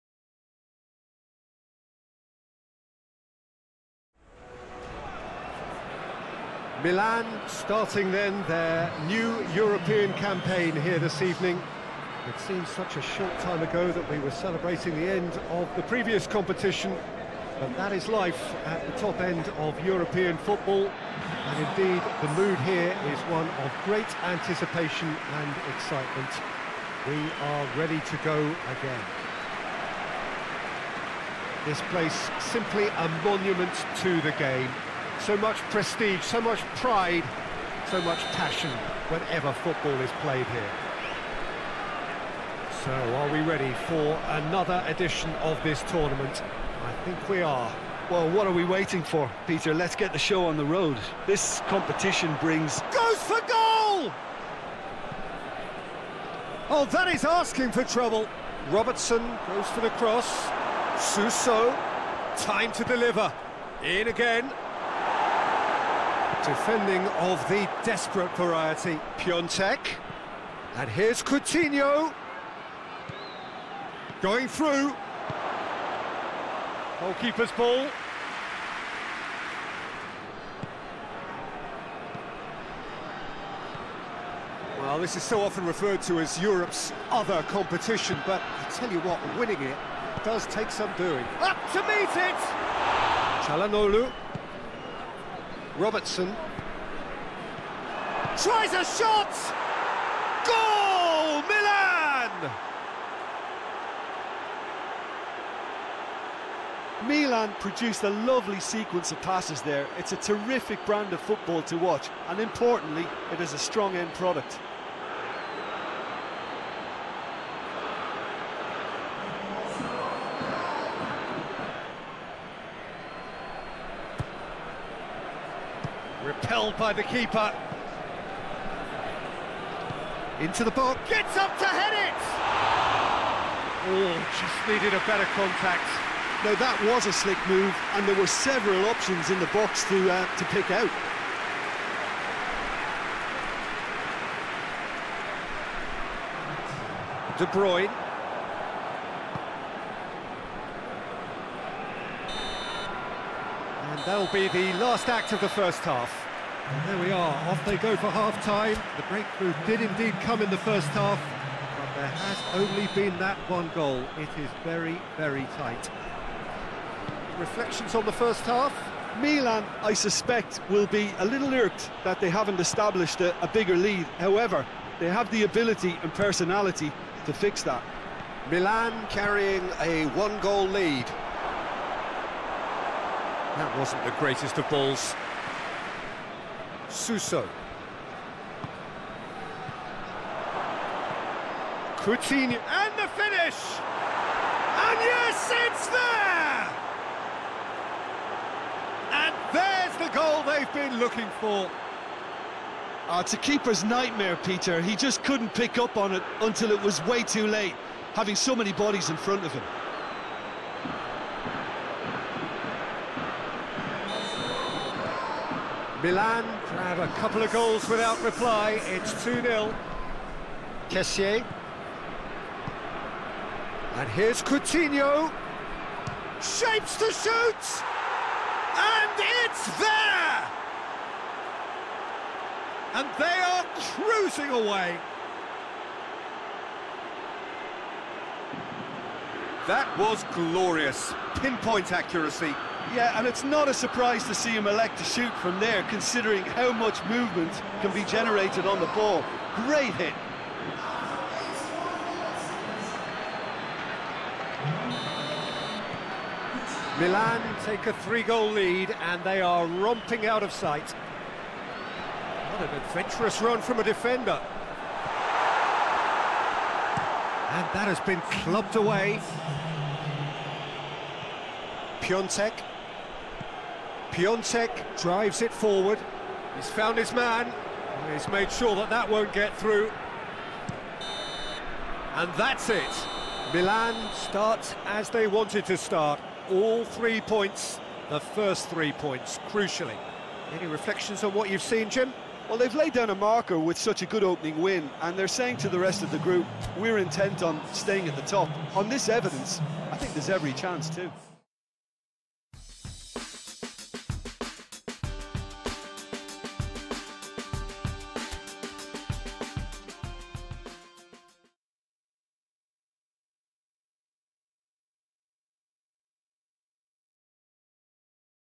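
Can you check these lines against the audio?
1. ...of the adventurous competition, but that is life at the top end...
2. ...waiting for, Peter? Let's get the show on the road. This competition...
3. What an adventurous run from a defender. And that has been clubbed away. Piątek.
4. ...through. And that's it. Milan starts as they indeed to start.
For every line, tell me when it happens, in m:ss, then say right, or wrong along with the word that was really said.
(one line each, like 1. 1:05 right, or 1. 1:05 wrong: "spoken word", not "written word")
1. 0:15 wrong: "previous", not "adventurous"
2. 0:48 right
3. 4:20 right
4. 4:39 wrong: "wanted", not "indeed".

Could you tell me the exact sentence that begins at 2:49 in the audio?
Milan, I suspect, will be a little irked that they haven't established a, a bigger lead.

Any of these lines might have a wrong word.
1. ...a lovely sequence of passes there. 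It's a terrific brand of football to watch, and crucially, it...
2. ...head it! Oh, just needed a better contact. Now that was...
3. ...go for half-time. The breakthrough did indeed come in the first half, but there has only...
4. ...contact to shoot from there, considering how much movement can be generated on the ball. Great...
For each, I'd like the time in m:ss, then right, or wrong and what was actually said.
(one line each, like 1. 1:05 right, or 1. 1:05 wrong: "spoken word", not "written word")
1. 1:48 wrong: "importantly", not "crucially"
2. 2:11 right
3. 2:37 right
4. 4:04 wrong: "elect", not "contact".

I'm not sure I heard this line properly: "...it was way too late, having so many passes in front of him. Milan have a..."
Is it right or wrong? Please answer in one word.
wrong.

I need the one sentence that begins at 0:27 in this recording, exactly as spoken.
We are ready to go again.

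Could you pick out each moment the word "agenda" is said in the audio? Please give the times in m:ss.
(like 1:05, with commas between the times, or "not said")
not said.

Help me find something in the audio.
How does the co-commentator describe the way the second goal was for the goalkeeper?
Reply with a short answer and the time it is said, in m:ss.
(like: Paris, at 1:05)
A keeper's nightmare, at 3:23.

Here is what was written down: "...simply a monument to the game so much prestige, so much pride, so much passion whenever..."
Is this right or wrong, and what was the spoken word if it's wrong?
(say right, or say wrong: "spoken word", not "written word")
right.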